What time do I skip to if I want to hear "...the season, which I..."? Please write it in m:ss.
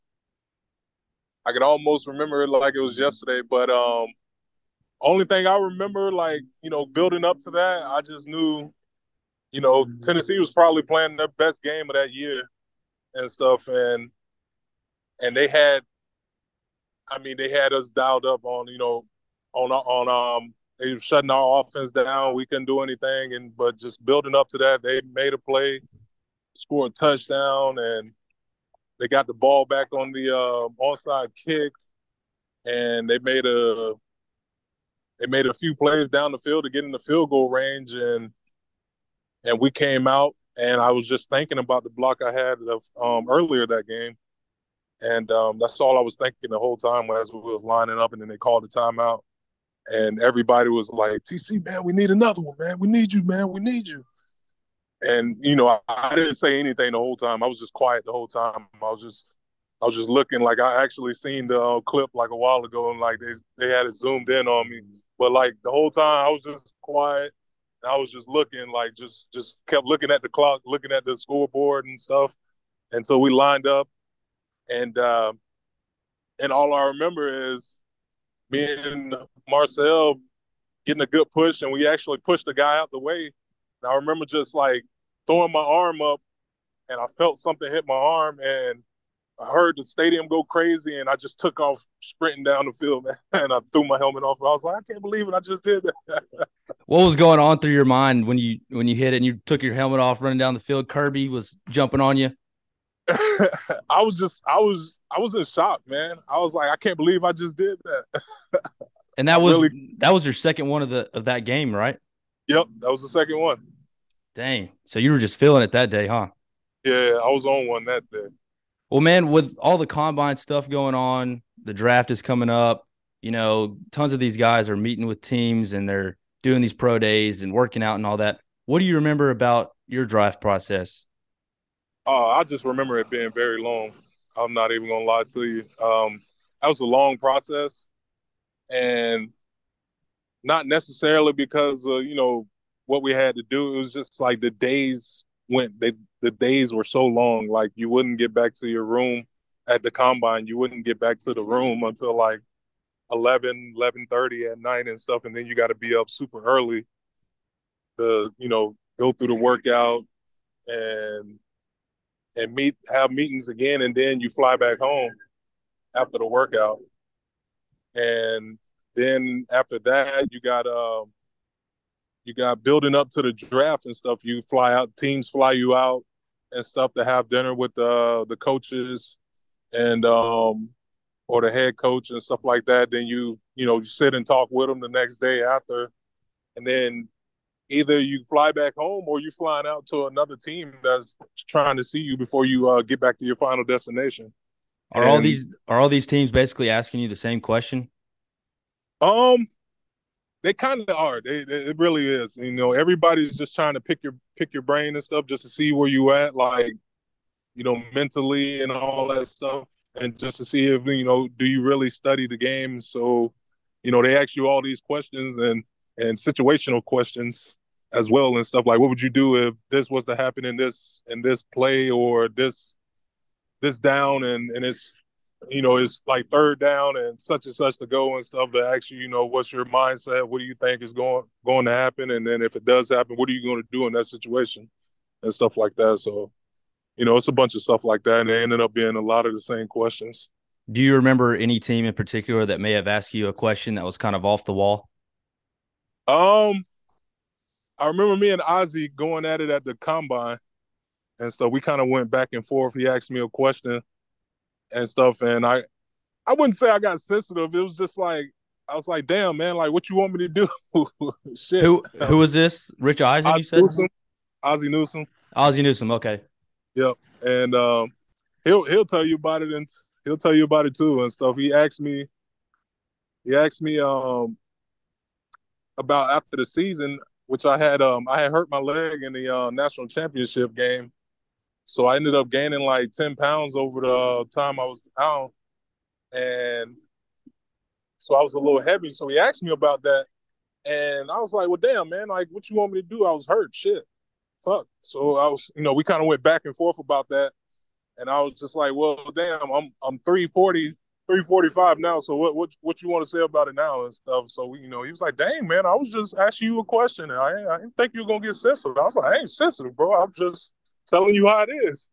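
4:36.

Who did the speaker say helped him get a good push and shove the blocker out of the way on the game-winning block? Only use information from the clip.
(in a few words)
Marcell.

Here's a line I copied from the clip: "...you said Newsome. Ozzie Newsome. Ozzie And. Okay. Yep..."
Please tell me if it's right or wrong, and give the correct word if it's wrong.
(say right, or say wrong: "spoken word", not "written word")
wrong: "Newsome", not "And".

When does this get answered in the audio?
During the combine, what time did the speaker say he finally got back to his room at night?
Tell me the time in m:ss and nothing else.
2:33.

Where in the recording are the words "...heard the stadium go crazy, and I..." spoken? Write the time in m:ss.
1:29.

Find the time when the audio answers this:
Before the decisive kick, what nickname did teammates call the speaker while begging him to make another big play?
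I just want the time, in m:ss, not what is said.
0:51.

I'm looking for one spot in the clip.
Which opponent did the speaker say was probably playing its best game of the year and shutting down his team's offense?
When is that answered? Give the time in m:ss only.
0:09.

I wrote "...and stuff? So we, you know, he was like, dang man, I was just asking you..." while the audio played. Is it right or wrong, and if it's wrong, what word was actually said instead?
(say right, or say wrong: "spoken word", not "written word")
right.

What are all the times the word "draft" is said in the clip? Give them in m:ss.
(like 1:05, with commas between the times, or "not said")
2:01, 2:53.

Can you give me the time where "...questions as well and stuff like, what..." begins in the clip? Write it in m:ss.
3:36.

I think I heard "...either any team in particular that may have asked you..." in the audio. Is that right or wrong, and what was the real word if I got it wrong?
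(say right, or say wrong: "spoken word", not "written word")
wrong: "remember", not "either".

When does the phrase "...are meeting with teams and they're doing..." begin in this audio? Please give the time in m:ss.
2:04.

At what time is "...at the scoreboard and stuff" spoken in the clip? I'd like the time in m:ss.
1:10.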